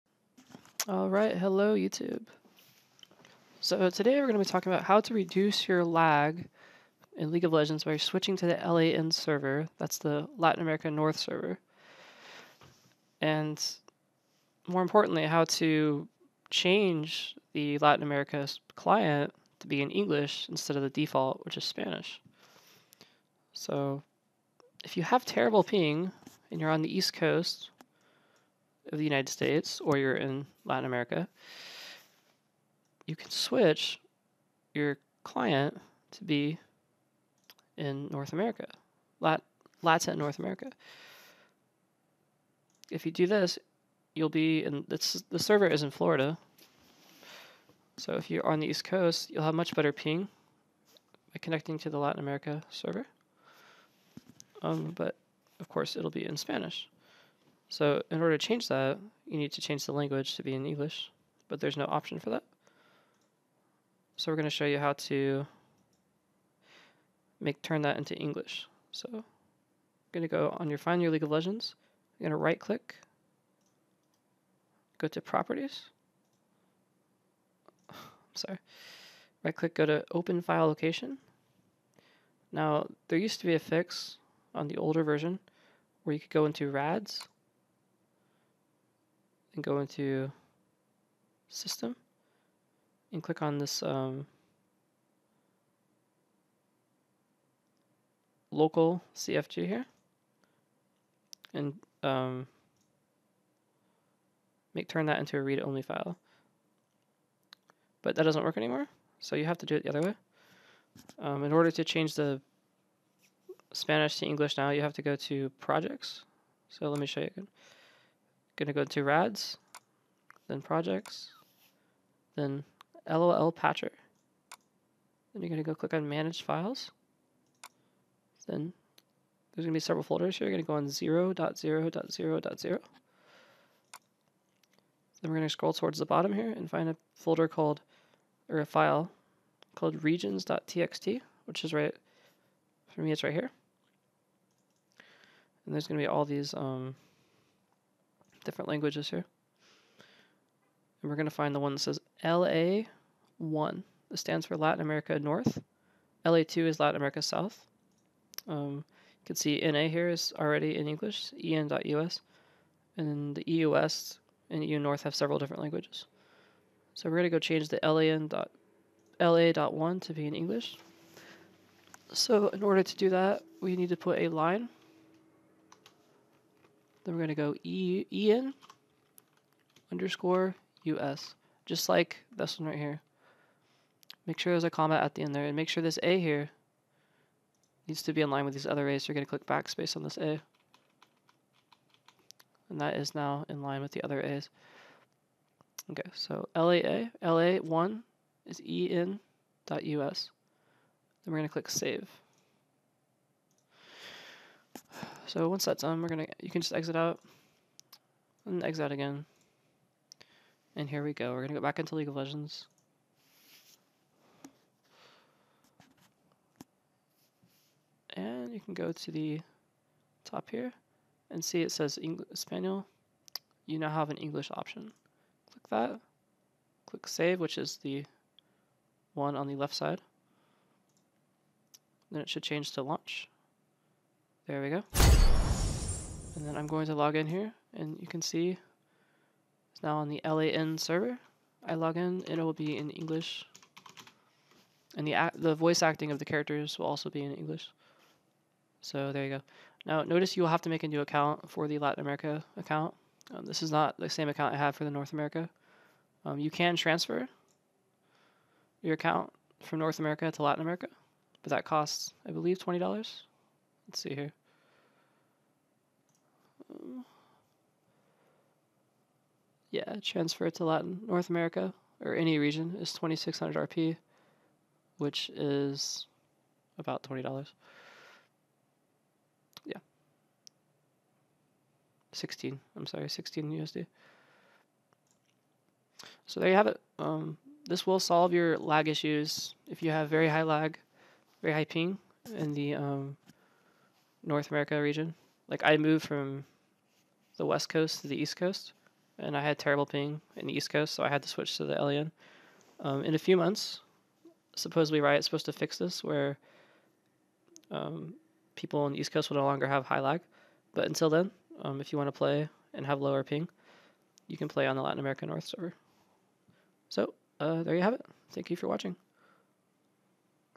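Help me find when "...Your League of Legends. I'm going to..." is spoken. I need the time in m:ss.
1:11.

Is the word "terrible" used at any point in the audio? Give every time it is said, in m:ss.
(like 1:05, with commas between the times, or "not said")
0:25, 4:59.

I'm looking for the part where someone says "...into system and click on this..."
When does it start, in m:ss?
1:29.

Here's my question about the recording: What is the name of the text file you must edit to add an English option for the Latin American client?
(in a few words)
regions.txt.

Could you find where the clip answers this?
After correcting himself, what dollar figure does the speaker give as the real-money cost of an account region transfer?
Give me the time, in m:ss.
4:43.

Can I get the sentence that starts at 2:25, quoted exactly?
And there's gonna be all these um, different languages here.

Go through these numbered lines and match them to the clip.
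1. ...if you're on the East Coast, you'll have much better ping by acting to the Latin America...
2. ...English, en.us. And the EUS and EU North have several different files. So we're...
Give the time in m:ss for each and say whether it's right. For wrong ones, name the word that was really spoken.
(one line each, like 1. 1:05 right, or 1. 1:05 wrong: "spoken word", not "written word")
1. 0:48 wrong: "connecting", not "acting"
2. 2:40 wrong: "languages", not "files".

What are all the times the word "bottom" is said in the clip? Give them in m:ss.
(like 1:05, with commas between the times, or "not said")
2:16.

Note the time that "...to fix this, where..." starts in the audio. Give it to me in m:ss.
5:05.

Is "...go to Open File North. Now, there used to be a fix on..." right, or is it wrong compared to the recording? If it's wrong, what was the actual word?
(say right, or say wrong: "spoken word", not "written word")
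wrong: "Location", not "North".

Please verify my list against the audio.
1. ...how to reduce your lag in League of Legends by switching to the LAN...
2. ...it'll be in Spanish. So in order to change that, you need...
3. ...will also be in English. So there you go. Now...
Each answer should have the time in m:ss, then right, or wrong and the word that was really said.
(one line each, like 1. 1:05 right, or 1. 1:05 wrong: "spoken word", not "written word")
1. 0:04 right
2. 0:55 right
3. 4:06 right.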